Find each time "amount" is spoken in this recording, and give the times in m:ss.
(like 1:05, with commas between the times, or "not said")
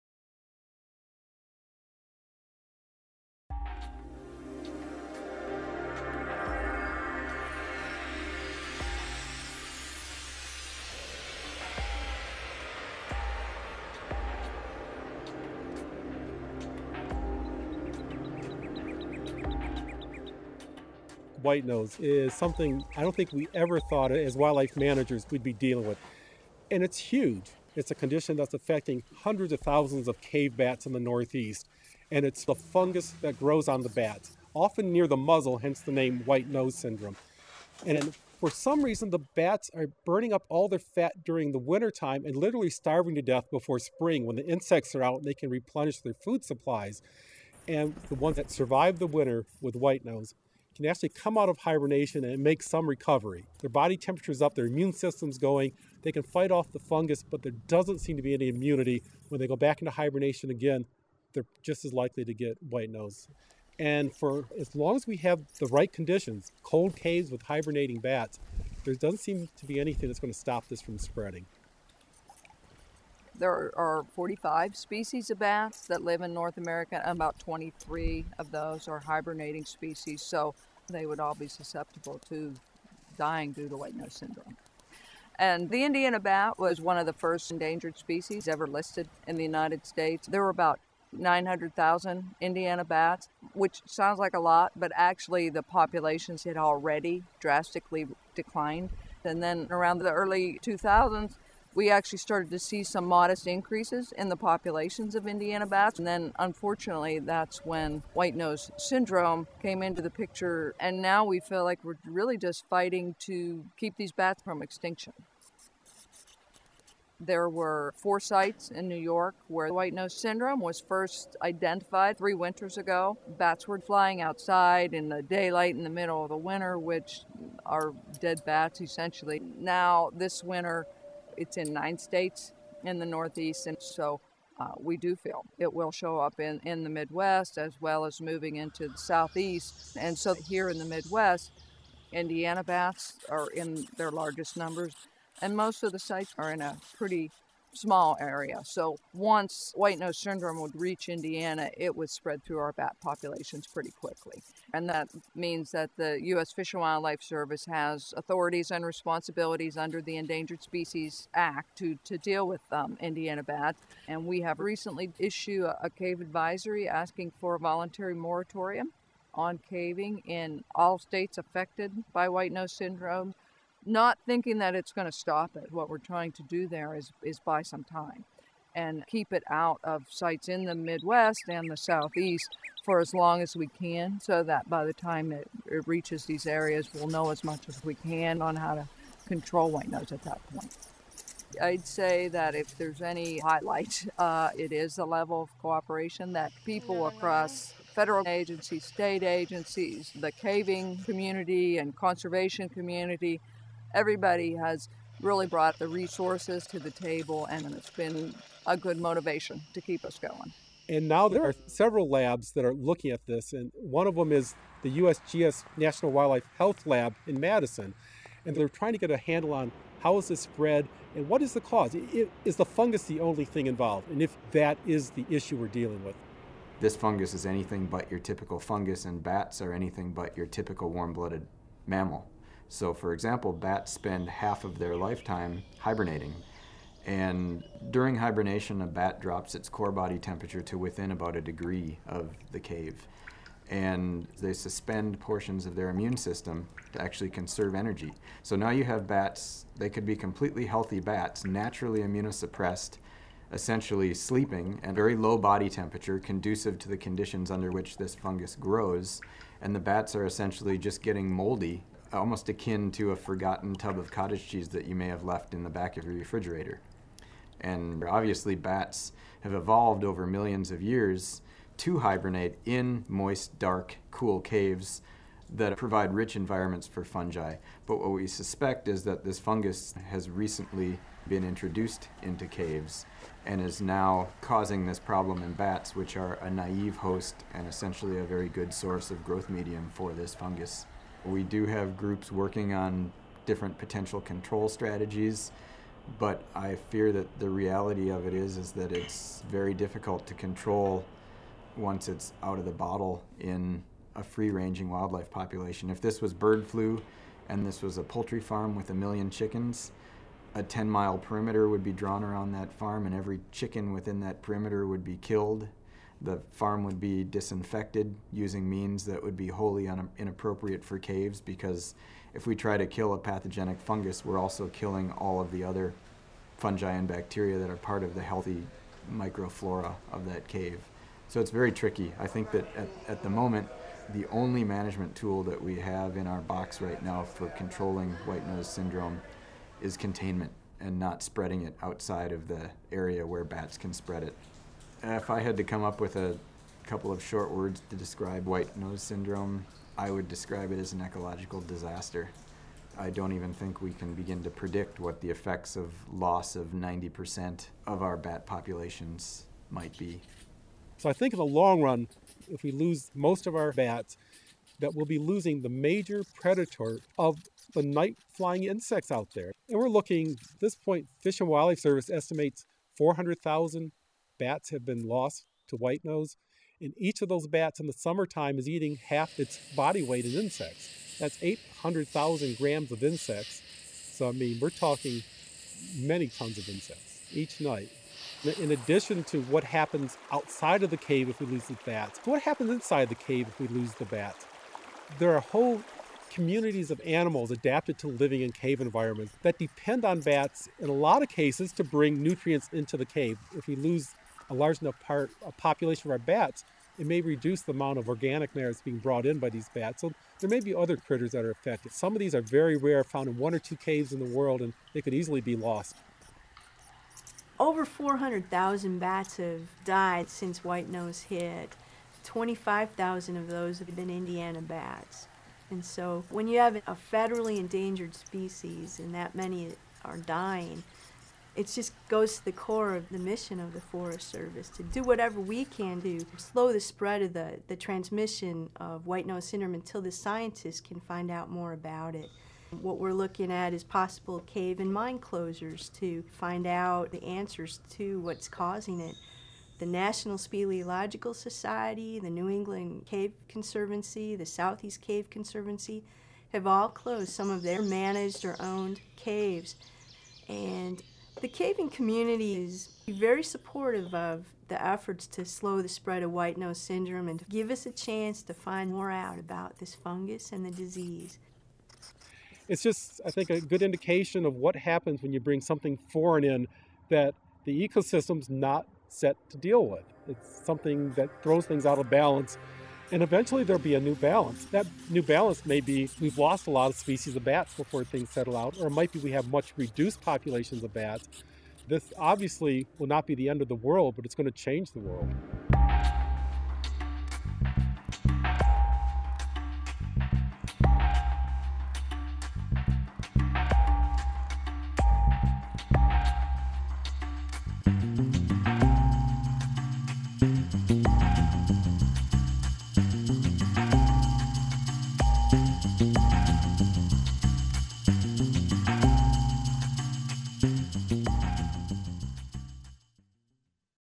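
6:47.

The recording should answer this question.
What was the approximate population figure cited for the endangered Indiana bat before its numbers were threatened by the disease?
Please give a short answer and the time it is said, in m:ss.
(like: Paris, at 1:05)
900,000, at 1:31.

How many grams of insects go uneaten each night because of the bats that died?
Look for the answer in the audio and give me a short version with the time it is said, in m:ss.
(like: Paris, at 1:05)
800,000, at 6:21.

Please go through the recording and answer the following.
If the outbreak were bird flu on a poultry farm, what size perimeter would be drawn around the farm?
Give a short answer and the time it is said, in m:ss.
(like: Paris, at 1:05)
10 miles, at 5:10.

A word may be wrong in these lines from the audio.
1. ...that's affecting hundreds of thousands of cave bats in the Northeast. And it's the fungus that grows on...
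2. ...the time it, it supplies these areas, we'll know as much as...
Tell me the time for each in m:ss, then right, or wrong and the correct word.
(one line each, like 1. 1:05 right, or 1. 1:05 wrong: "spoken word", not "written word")
1. 0:28 right
2. 3:04 wrong: "reaches", not "supplies".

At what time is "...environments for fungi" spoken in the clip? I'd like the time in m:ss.
4:36.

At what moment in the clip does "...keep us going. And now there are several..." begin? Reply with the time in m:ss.
3:29.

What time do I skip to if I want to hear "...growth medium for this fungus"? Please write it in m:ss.
4:49.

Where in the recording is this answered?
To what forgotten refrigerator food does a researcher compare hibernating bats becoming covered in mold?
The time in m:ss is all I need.
4:24.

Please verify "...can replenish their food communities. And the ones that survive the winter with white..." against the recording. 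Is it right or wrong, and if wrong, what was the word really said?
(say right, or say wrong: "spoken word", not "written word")
wrong: "supplies", not "communities".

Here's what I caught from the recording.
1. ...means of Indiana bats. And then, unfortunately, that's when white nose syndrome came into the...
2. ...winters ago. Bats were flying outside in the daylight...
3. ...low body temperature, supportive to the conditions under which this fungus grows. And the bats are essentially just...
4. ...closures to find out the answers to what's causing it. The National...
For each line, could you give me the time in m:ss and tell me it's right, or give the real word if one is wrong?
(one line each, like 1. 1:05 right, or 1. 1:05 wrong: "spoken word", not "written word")
1. 1:44 wrong: "populations", not "means"
2. 2:02 right
3. 4:15 wrong: "conducive", not "supportive"
4. 7:25 right.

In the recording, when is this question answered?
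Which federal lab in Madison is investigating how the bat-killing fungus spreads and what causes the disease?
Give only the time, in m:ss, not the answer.
3:34.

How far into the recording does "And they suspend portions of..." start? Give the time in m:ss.
4:03.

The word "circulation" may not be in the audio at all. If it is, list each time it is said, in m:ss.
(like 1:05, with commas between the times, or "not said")
not said.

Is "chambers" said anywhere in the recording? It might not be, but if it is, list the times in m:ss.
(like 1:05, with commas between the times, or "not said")
not said.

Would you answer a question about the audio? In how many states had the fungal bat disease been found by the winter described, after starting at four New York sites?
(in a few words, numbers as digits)
9.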